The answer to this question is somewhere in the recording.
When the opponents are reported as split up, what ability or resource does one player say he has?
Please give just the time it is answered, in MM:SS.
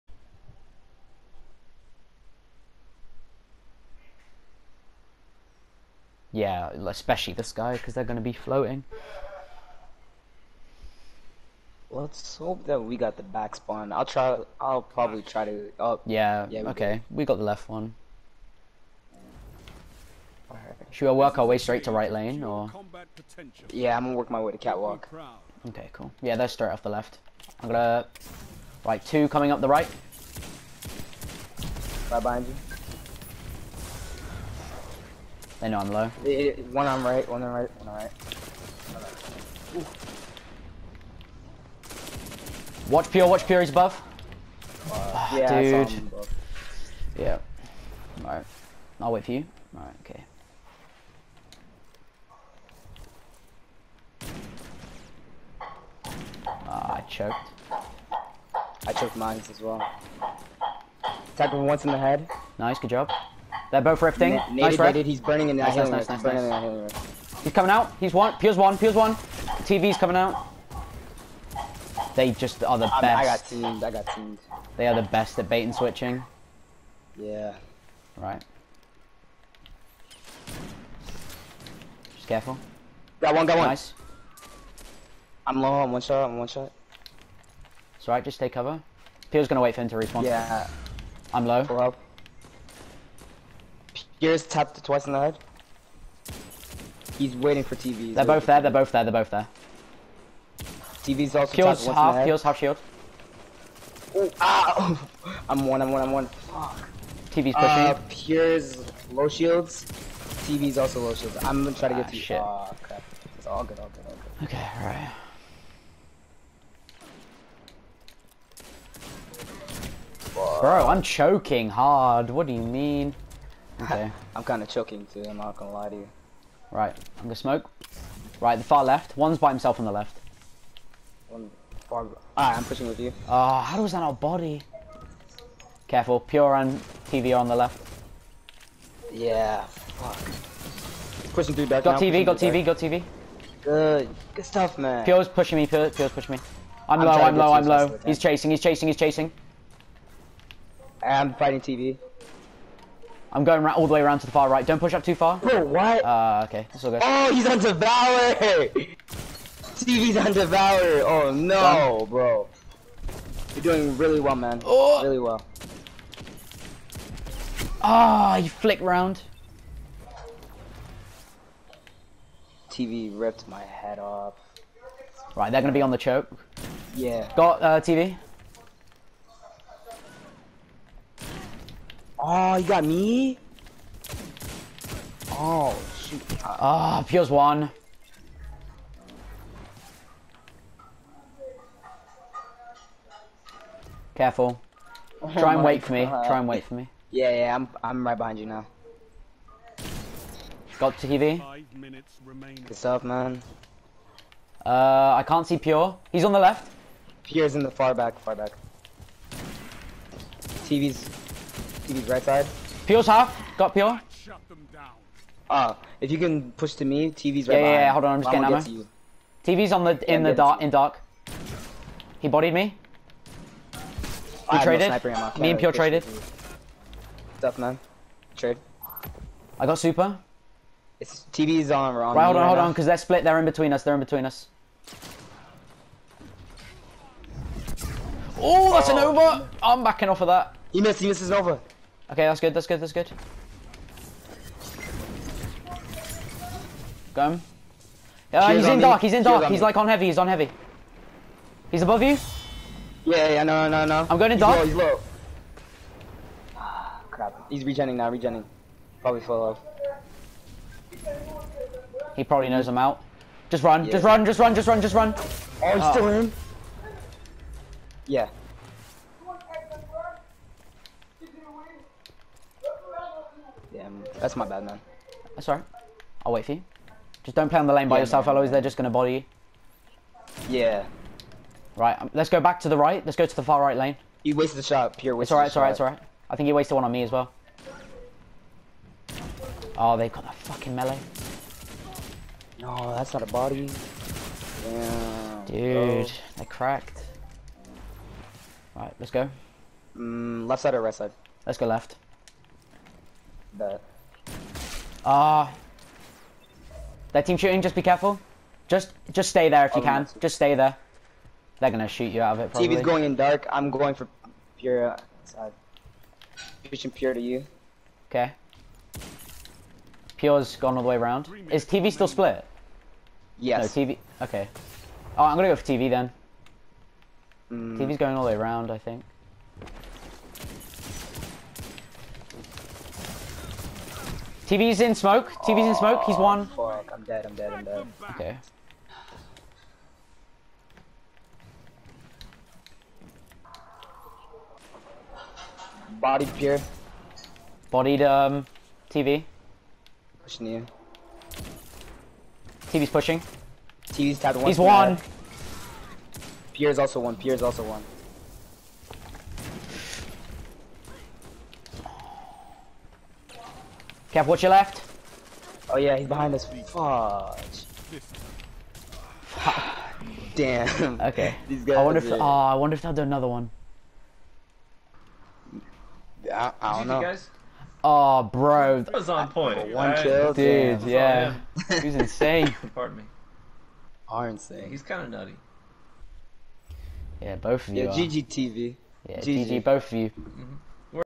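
03:49.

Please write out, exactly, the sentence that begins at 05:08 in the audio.
Just, just stay there if you oh, can.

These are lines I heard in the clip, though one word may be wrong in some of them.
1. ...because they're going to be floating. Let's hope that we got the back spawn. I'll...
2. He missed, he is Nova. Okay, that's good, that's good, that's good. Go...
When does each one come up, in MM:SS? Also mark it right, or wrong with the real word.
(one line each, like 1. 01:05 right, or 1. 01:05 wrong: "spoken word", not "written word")
1. 00:07 right
2. 04:00 right.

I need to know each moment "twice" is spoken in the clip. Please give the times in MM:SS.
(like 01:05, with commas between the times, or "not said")
01:34.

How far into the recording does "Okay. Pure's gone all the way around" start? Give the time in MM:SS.
05:18.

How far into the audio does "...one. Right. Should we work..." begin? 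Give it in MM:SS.
00:17.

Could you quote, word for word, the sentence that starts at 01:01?
Attack him once in the head.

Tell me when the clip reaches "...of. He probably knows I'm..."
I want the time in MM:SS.
04:19.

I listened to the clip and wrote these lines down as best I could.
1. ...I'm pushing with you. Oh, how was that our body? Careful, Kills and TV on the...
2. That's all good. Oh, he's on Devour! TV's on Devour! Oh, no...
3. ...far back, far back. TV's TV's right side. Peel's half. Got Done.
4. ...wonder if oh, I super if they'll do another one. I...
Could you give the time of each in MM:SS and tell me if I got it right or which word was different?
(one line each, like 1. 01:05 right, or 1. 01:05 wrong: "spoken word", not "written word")
1. 02:12 wrong: "Pure", not "Kills"
2. 02:36 right
3. 03:27 wrong: "Peel", not "Done"
4. 06:11 wrong: "wonder", not "super".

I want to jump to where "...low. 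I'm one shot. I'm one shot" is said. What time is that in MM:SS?
01:25.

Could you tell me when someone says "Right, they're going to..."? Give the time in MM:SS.
02:55.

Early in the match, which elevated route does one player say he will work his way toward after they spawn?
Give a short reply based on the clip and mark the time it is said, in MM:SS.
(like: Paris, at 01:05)
Catwalk, at 00:24.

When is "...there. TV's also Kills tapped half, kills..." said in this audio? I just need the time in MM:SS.
01:39.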